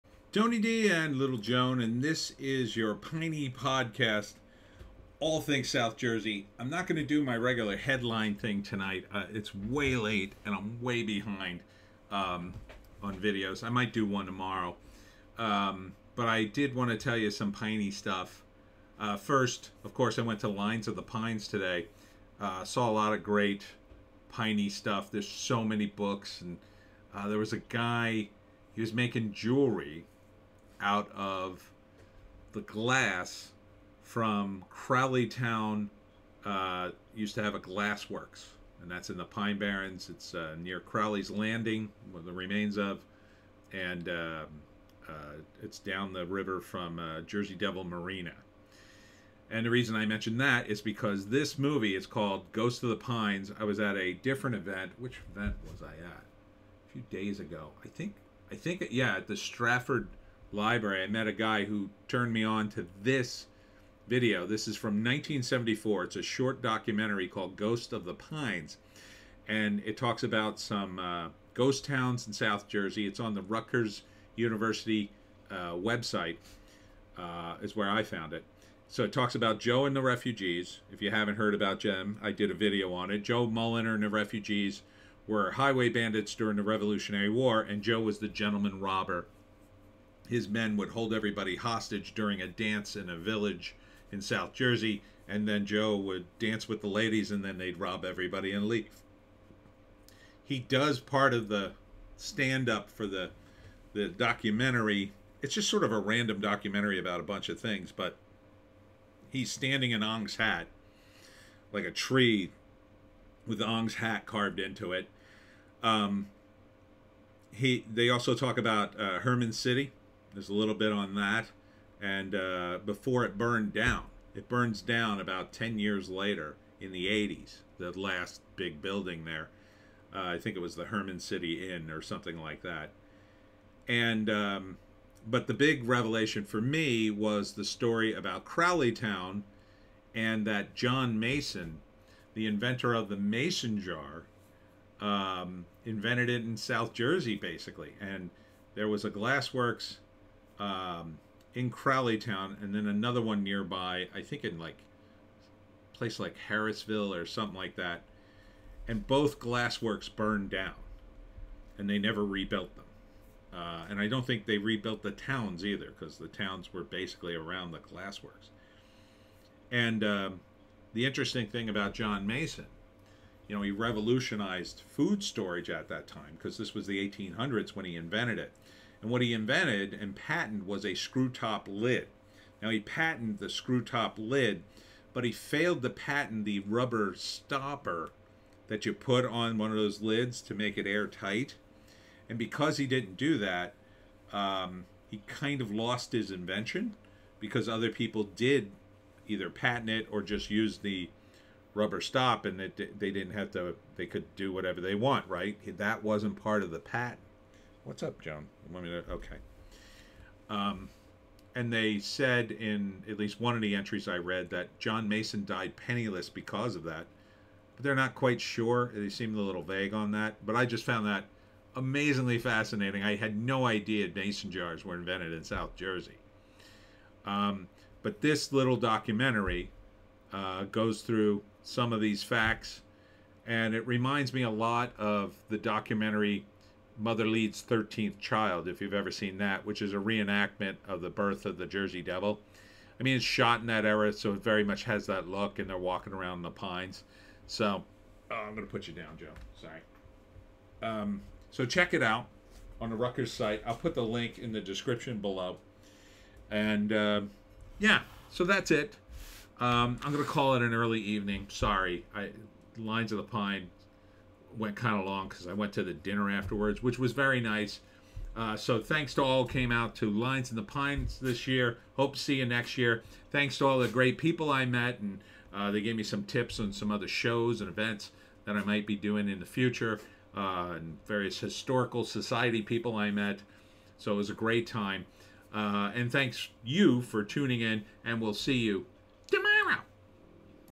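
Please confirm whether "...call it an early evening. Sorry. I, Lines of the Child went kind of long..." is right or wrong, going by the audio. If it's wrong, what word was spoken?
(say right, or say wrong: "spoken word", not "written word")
wrong: "Pine", not "Child".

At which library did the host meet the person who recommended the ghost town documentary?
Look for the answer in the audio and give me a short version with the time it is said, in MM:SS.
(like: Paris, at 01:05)
Stratford library, at 00:59.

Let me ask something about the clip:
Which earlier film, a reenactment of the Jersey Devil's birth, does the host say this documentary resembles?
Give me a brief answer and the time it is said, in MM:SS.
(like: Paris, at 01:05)
Mother Leeds' 13th Child, at 03:57.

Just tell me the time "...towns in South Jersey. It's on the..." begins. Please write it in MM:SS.
01:11.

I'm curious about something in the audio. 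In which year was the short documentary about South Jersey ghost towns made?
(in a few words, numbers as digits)
1974.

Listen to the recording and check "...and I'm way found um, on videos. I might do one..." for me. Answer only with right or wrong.
wrong.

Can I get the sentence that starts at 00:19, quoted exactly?
Uh, first, of course, I went to Lines of the Pines today.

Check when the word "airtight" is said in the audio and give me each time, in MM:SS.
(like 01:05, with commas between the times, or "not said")
03:10.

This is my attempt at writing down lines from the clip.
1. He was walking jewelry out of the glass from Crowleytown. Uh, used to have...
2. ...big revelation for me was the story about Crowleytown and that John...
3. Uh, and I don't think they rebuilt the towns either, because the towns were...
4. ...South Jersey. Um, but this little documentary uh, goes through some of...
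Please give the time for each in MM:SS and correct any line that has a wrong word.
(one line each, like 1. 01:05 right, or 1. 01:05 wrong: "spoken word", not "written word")
1. 00:28 wrong: "making", not "walking"
2. 02:15 right
3. 02:43 right
4. 03:45 right.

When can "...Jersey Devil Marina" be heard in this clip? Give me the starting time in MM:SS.
00:47.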